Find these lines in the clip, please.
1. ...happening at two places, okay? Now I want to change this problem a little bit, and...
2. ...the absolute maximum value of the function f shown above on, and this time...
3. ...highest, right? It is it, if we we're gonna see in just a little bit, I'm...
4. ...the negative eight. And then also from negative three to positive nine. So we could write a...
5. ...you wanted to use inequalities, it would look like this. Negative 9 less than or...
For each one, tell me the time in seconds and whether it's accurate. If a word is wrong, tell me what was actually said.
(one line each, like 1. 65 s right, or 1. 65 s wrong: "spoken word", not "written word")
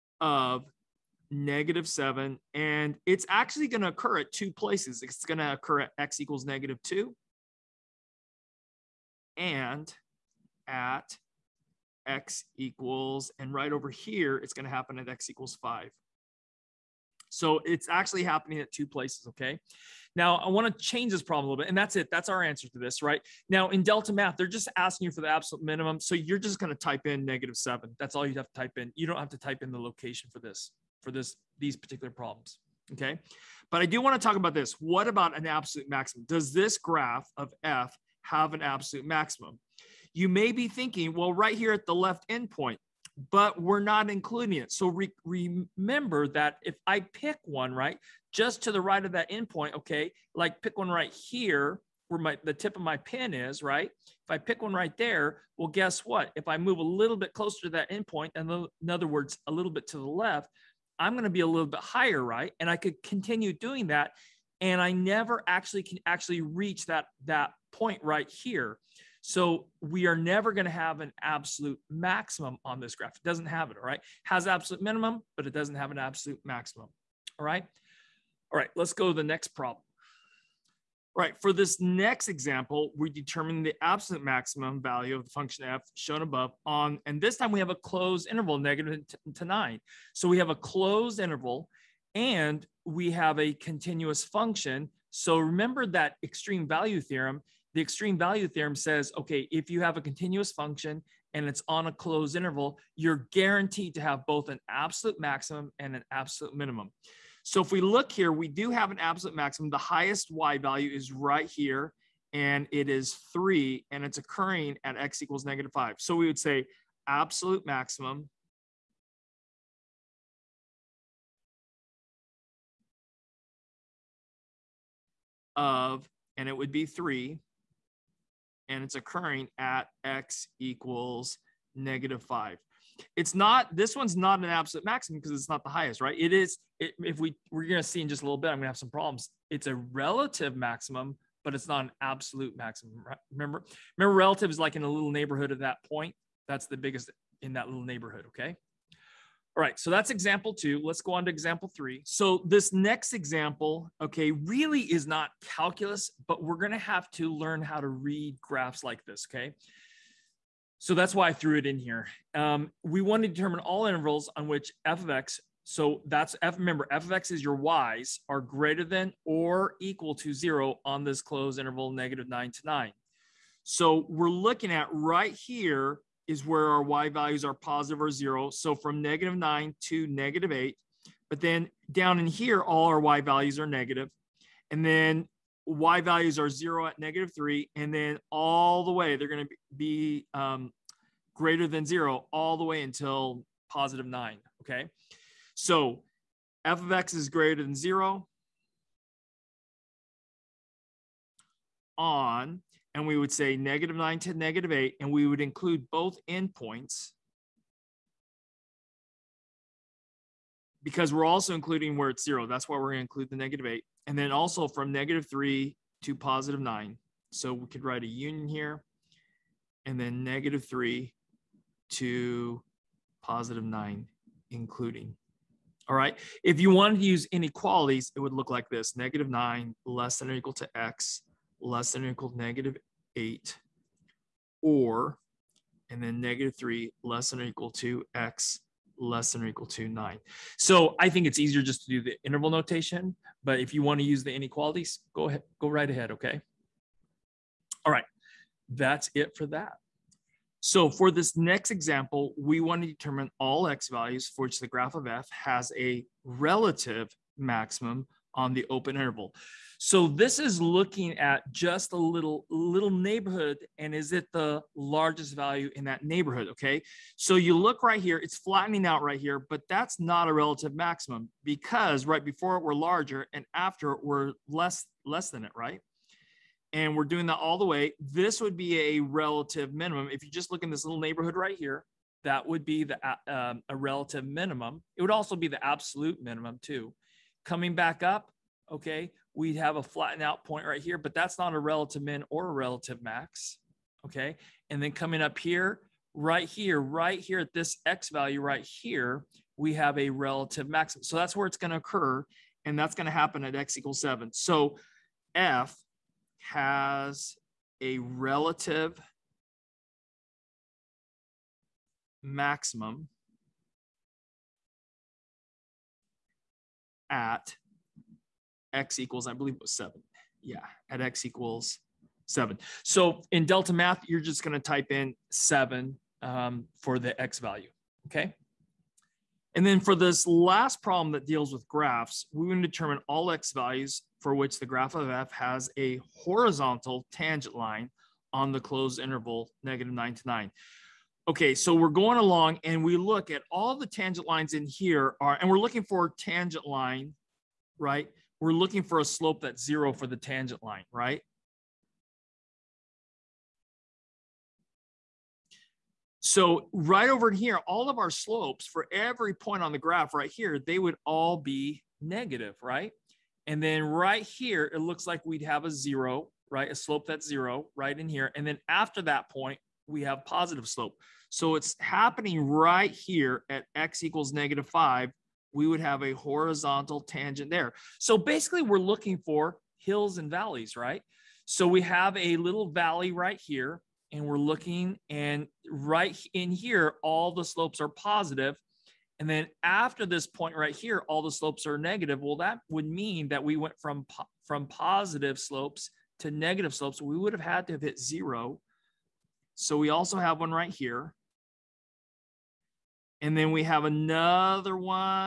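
1. 18 s right
2. 83 s right
3. 135 s right
4. 213 s right
5. 226 s right.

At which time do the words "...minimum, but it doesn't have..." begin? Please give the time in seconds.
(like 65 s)
74 s.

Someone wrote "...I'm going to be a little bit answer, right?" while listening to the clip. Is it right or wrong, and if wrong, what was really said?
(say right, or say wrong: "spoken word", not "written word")
wrong: "higher", not "answer".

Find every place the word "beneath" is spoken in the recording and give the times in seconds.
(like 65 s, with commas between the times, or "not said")
not said.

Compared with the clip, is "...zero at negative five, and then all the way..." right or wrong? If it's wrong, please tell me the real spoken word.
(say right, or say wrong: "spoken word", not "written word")
wrong: "three", not "five".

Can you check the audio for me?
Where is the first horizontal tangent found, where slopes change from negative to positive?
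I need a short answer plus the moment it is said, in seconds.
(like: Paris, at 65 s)
x = -5, at 373 s.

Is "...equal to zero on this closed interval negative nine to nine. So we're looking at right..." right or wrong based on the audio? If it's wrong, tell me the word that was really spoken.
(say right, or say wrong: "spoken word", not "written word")
right.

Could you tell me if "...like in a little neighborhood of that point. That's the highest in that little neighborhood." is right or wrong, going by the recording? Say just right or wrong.
wrong.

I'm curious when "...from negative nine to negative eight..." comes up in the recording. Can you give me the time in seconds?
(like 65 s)
178 s.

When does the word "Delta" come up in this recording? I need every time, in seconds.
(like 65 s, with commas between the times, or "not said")
23 s, 323 s.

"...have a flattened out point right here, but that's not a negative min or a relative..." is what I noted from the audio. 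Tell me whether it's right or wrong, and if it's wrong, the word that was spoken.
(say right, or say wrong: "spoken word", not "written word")
wrong: "relative", not "negative".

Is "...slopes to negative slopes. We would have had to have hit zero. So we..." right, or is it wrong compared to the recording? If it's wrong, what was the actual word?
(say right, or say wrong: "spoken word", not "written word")
right.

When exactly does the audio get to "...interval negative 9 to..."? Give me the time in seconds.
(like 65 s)
338 s.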